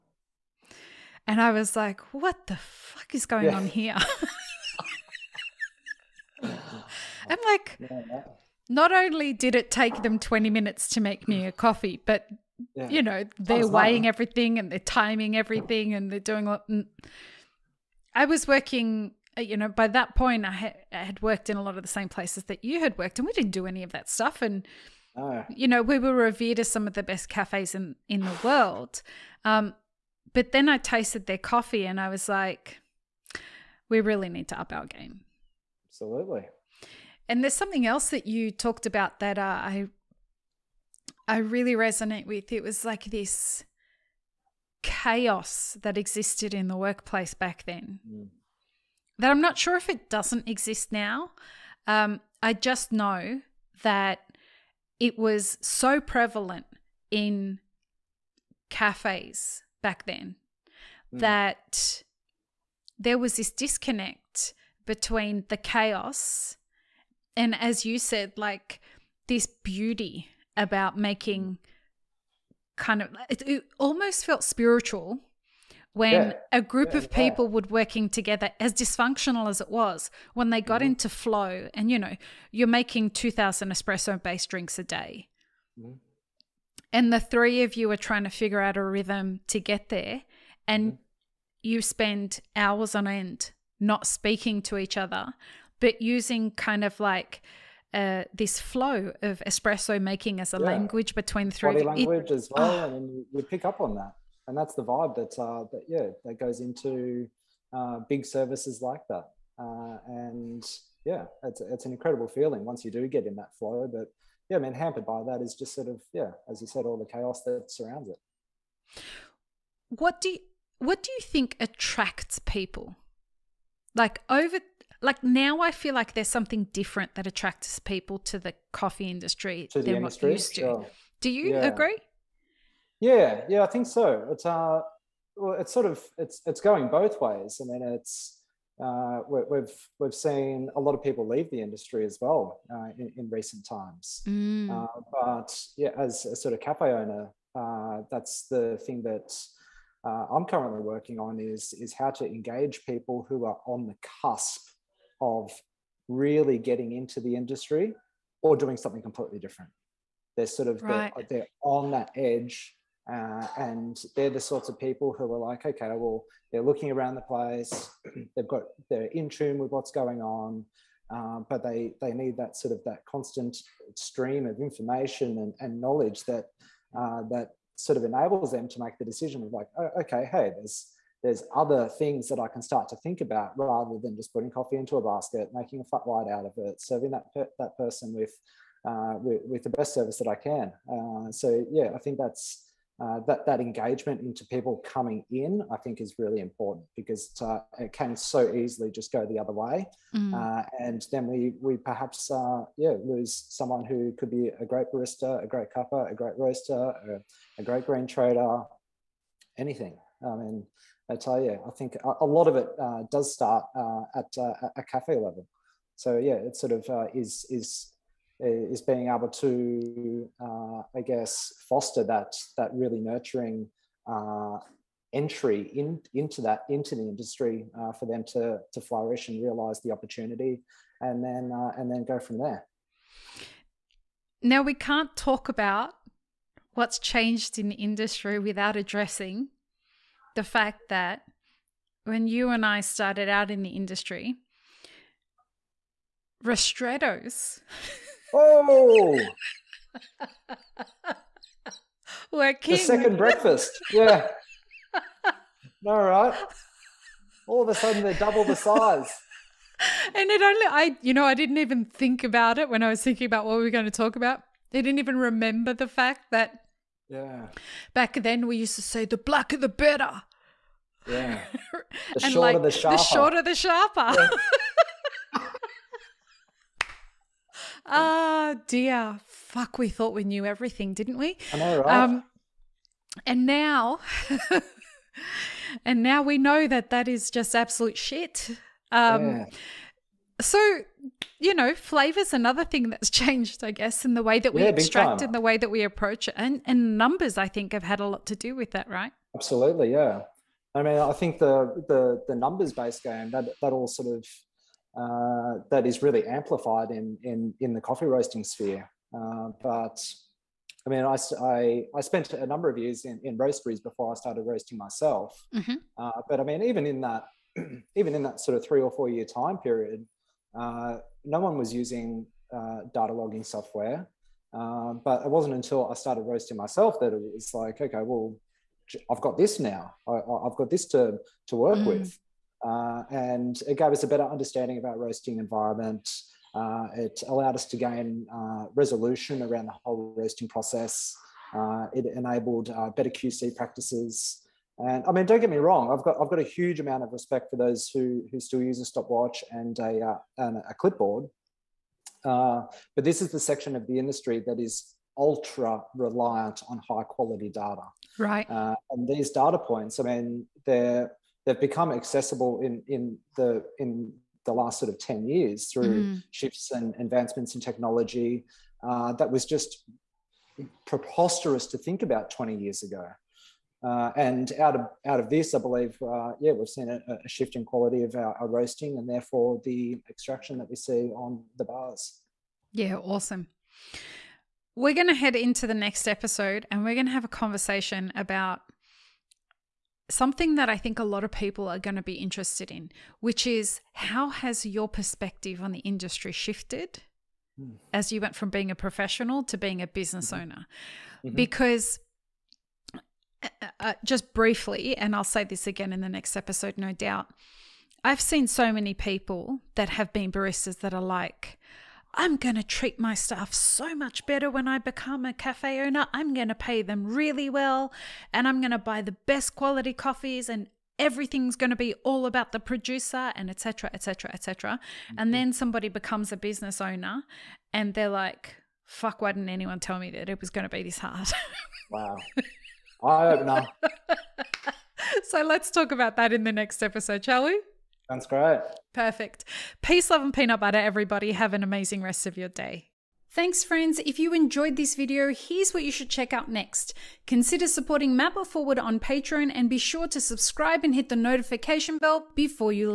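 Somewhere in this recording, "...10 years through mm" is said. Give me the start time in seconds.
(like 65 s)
364 s.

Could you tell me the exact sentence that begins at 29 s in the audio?
Um, but then I tasted their coffee and I was like, we really need to up our game.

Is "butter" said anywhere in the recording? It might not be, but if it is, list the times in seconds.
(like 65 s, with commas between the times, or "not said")
440 s.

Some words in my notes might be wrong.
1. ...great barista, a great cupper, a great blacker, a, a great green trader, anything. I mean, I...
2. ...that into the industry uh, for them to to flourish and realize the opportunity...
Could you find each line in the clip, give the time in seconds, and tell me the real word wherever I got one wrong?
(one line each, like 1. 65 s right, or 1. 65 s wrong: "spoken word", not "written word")
1. 204 s wrong: "roaster", not "blacker"
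2. 226 s right.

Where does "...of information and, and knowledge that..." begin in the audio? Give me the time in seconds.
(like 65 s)
174 s.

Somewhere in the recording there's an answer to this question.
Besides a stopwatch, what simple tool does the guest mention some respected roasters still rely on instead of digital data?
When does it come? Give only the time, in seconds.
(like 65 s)
350 s.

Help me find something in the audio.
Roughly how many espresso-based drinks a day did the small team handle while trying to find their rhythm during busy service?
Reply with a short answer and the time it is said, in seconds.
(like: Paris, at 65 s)
2000, at 83 s.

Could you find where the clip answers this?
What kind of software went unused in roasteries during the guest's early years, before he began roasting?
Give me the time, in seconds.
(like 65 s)
322 s.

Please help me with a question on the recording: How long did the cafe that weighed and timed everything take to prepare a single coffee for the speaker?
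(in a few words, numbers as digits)
20 minutes.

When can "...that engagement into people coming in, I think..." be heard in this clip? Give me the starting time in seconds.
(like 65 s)
193 s.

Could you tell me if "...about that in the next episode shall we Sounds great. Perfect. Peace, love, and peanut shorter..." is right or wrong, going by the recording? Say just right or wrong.
wrong.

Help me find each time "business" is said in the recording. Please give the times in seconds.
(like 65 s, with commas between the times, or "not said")
399 s, 426 s.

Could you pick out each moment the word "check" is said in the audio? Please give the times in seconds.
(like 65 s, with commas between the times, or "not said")
446 s.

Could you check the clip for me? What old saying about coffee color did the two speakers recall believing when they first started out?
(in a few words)
the blacker the better.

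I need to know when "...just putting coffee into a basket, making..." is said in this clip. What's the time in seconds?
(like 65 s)
184 s.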